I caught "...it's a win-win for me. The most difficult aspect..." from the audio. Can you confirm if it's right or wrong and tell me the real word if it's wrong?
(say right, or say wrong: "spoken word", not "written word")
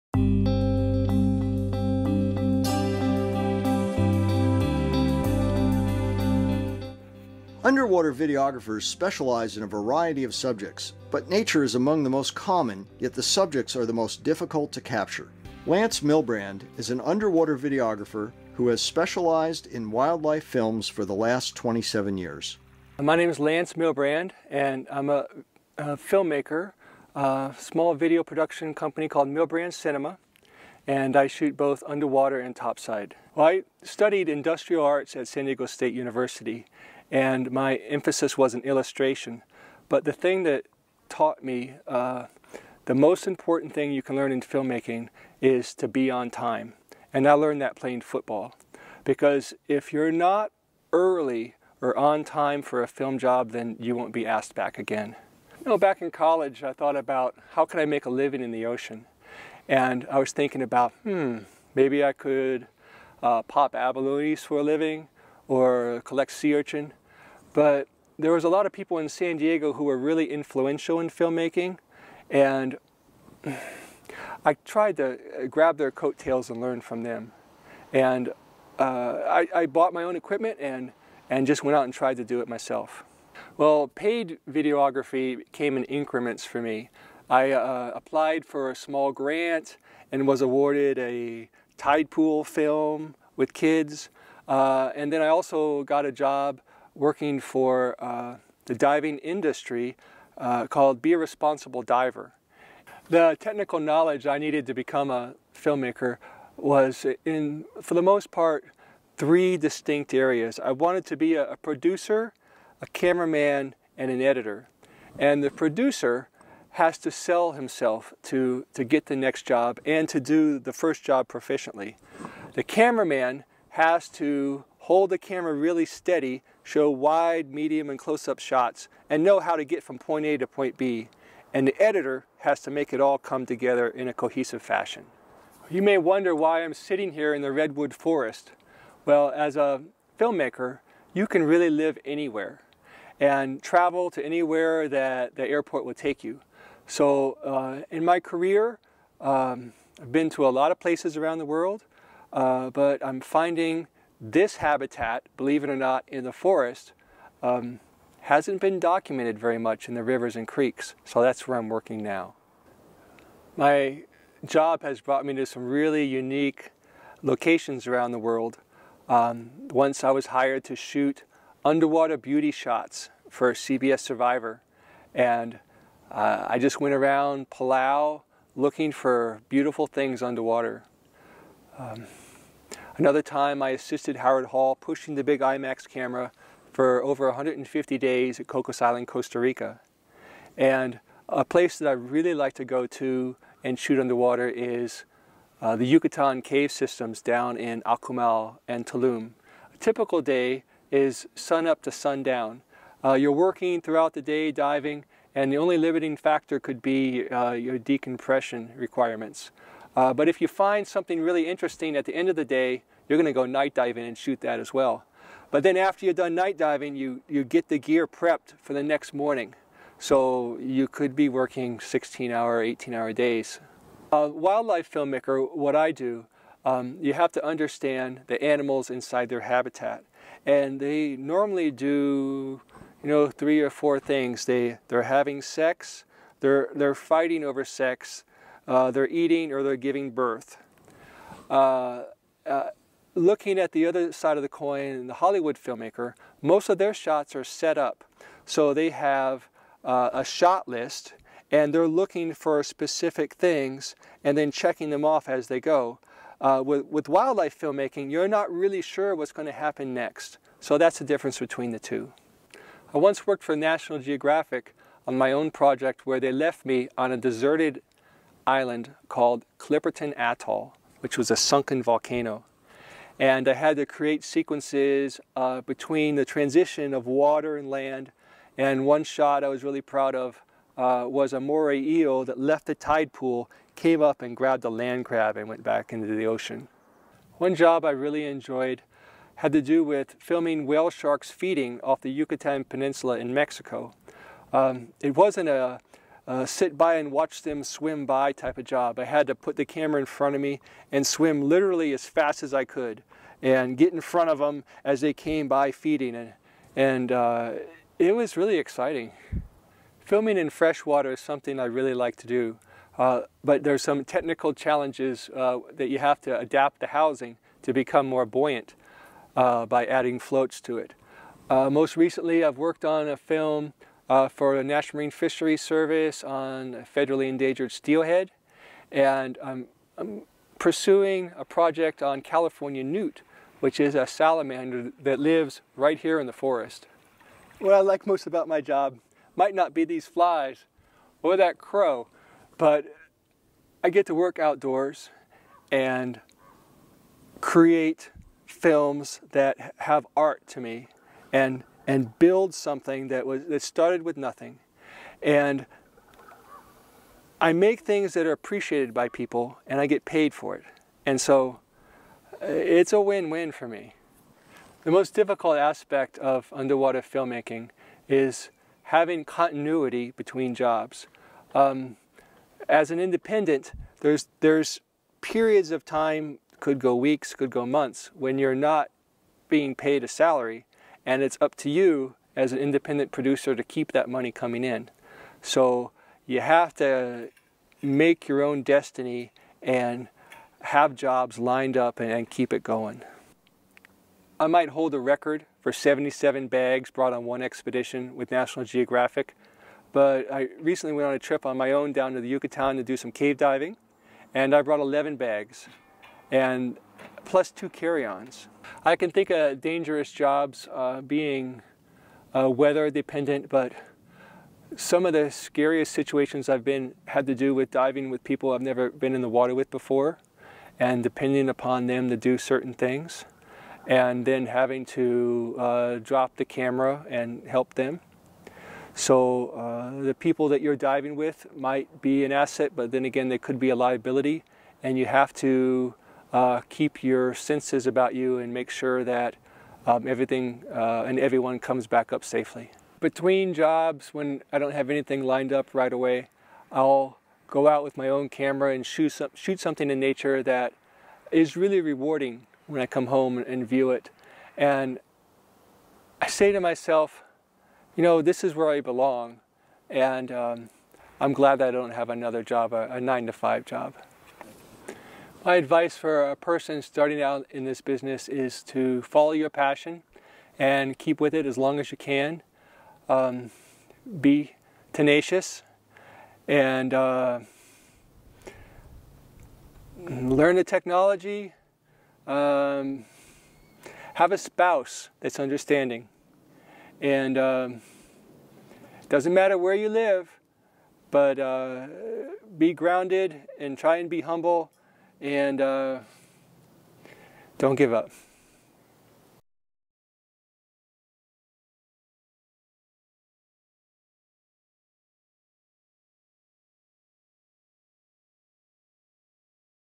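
right.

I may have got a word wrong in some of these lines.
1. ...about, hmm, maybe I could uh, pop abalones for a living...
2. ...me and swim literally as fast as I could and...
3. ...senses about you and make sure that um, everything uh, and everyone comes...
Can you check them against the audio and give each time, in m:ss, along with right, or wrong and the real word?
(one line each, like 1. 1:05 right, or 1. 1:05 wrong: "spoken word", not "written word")
1. 1:00 right
2. 5:00 right
3. 7:17 right.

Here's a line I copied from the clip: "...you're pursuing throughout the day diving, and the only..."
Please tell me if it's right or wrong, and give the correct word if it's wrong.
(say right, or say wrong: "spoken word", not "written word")
wrong: "working", not "pursuing".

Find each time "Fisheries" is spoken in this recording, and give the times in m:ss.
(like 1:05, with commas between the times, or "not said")
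5:25.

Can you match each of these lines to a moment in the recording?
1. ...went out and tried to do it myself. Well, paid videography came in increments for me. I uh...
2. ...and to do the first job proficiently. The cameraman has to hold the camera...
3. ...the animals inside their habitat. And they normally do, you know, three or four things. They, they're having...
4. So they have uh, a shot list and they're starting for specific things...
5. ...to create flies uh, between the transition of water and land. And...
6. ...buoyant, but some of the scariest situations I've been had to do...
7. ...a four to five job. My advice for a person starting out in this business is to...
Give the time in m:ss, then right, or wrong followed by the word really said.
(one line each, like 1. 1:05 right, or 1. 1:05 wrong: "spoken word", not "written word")
1. 1:21 right
2. 1:59 right
3. 3:48 right
4. 4:08 wrong: "looking", not "starting"
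5. 4:33 wrong: "sequences", not "flies"
6. 6:52 wrong: "dependent", not "buoyant"
7. 7:42 wrong: "nine", not "four".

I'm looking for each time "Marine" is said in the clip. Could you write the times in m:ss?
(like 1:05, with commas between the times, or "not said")
5:24.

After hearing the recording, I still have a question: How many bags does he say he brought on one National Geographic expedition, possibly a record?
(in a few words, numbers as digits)
77.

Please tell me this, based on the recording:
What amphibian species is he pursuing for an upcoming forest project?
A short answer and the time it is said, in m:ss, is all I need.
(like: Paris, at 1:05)
California newt, at 5:32.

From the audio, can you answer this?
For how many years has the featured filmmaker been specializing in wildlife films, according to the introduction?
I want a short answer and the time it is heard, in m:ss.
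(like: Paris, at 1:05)
27, at 0:21.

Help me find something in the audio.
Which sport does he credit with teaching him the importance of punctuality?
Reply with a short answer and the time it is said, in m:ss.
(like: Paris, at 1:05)
Football, at 0:48.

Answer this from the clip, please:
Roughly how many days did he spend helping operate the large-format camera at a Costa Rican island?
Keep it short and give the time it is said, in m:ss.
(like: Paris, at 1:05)
150, at 3:07.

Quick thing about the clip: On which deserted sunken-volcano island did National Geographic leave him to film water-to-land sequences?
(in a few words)
Clipperton Atoll.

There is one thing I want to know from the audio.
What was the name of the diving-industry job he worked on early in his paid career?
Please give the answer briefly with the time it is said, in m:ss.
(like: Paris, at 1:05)
Be a Responsible Diver, at 1:41.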